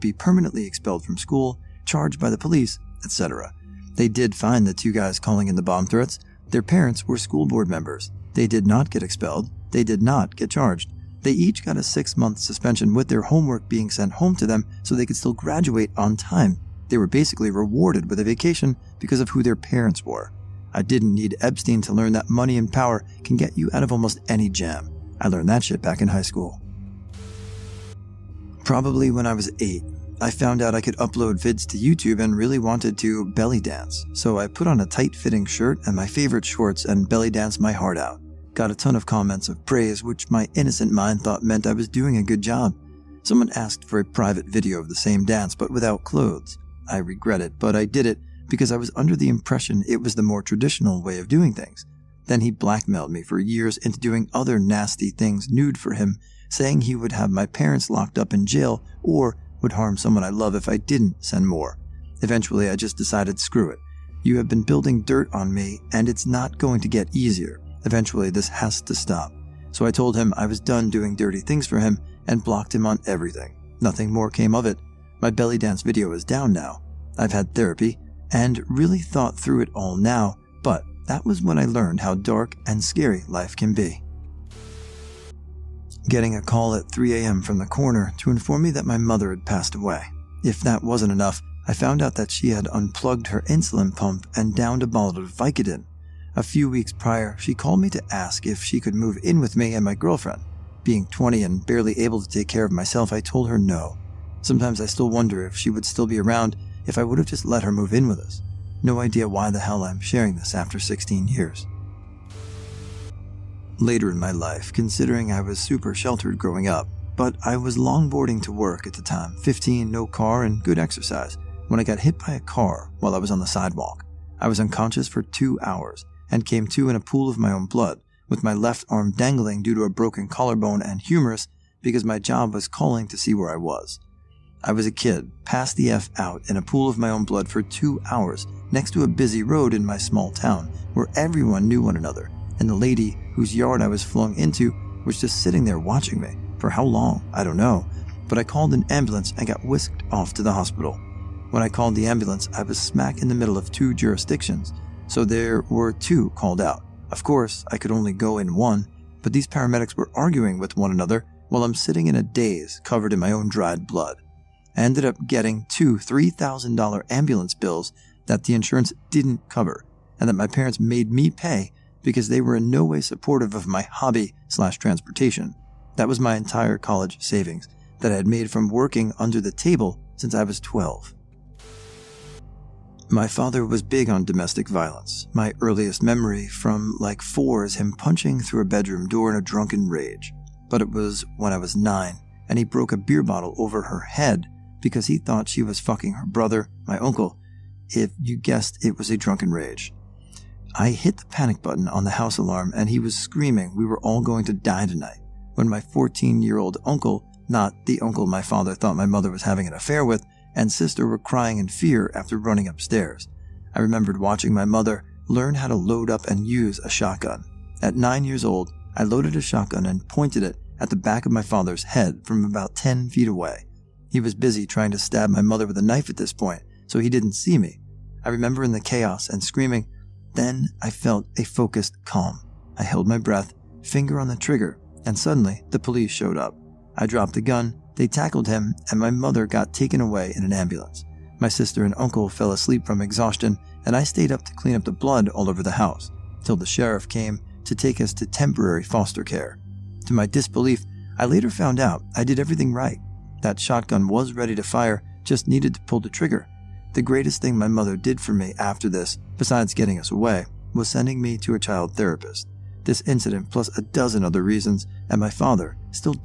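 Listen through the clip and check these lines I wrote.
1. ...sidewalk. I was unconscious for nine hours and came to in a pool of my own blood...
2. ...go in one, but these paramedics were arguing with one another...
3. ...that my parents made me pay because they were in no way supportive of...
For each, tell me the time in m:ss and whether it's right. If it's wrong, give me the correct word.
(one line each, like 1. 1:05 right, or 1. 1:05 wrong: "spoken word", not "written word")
1. 2:03 wrong: "two", not "nine"
2. 2:38 right
3. 2:50 right.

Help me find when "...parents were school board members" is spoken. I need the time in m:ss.
0:06.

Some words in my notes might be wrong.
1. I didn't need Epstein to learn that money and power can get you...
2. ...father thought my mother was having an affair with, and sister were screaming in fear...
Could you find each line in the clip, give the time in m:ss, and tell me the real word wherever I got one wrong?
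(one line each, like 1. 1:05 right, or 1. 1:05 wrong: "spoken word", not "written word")
1. 0:20 right
2. 3:28 wrong: "crying", not "screaming".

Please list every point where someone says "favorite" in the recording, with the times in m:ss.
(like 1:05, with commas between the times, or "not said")
0:36.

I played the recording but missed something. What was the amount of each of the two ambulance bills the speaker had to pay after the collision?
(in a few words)
$3,000.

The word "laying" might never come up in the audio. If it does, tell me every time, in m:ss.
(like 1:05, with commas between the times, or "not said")
not said.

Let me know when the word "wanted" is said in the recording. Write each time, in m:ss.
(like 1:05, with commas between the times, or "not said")
0:32.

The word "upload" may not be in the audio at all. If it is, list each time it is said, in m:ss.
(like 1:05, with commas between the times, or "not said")
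0:30.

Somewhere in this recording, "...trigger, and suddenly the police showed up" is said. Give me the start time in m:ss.
3:54.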